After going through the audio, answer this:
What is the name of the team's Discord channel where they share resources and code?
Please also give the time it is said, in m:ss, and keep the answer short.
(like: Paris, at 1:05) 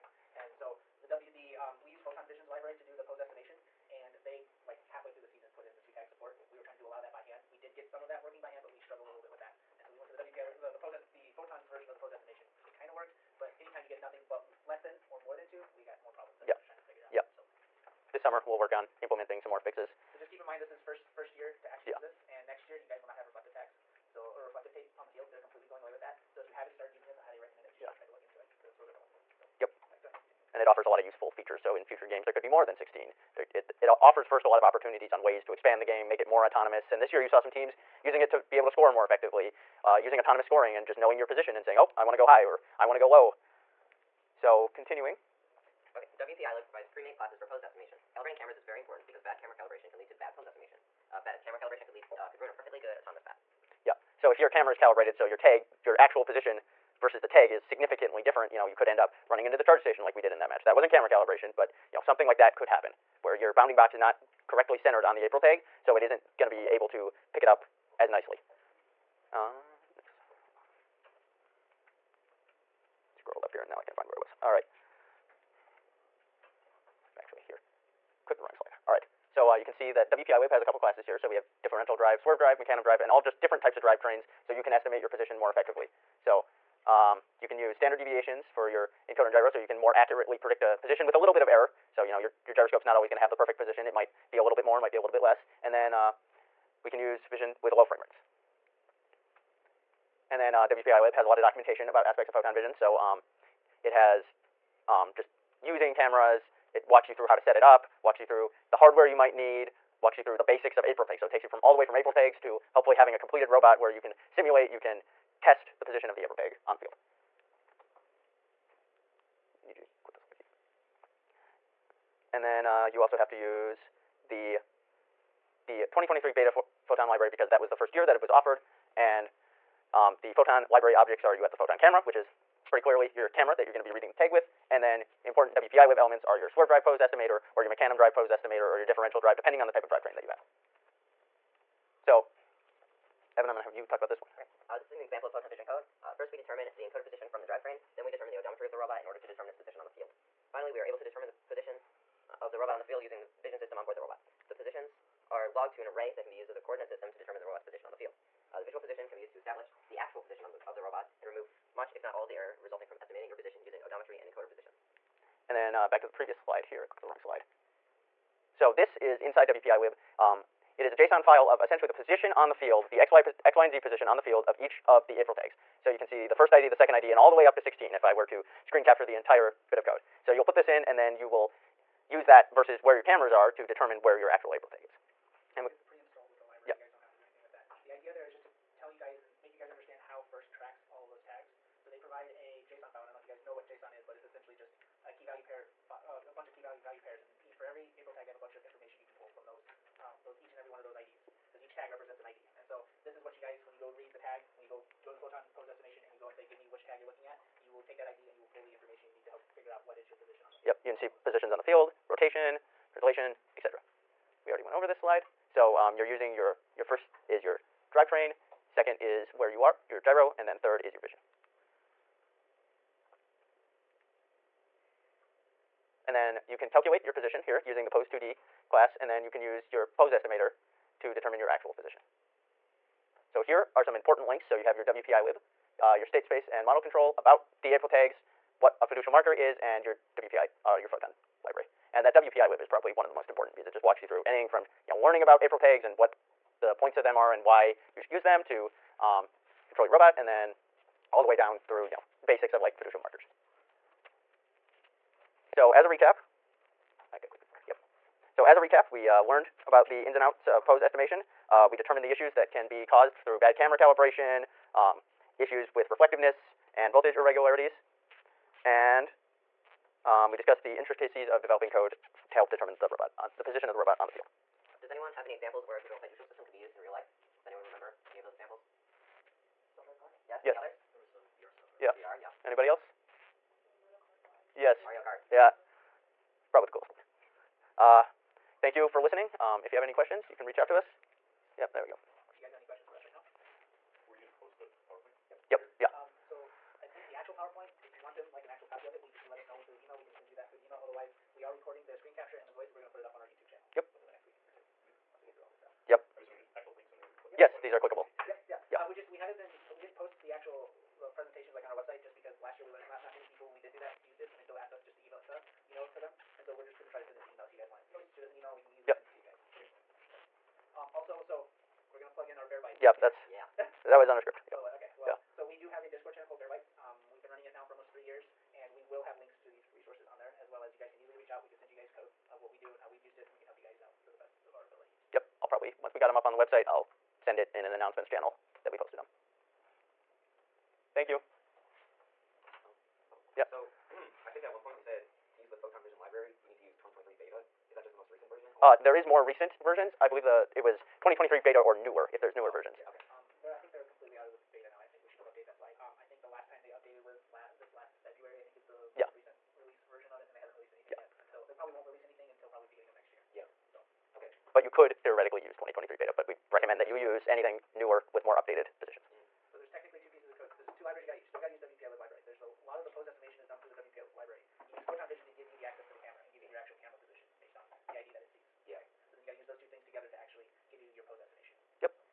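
Bear Bites, at 5:26.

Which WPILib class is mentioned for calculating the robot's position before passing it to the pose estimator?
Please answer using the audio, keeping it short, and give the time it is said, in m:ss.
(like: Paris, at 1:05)
Pose2D, at 3:47.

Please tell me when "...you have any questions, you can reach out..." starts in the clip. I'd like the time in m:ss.
4:49.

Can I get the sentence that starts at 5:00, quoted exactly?
Otherwise, we are recording the screen capture and the voice, and we're going to put it up on our YouTube channel.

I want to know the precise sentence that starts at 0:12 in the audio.
It kind of worked, but anytime you get nothing but less than or more than two, we got more problems.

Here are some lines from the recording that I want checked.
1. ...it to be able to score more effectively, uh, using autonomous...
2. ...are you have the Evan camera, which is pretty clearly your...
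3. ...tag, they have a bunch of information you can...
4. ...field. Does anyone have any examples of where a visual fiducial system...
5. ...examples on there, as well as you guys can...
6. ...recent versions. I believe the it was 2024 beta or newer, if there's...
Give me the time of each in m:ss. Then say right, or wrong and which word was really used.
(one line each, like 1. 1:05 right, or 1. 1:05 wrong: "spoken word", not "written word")
1. 0:38 right
2. 2:11 wrong: "Photon", not "Evan"
3. 3:18 right
4. 4:34 right
5. 5:29 wrong: "resources", not "examples"
6. 5:49 wrong: "2023", not "2024".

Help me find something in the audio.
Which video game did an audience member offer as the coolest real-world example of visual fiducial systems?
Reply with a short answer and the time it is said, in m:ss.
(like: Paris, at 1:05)
Mario Kart, at 4:44.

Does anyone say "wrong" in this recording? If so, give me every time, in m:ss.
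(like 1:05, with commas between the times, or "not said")
1:18, 2:47.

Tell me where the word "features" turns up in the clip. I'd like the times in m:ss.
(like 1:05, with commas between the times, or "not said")
0:31.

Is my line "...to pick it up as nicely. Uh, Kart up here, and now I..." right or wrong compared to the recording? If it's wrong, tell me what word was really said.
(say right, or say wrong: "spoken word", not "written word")
wrong: "Scroll", not "Kart".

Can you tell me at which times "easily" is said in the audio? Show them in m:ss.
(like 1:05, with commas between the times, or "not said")
5:18, 5:31.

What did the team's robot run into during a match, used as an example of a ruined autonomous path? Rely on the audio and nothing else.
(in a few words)
the charge station.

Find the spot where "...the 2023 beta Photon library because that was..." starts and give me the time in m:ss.
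2:05.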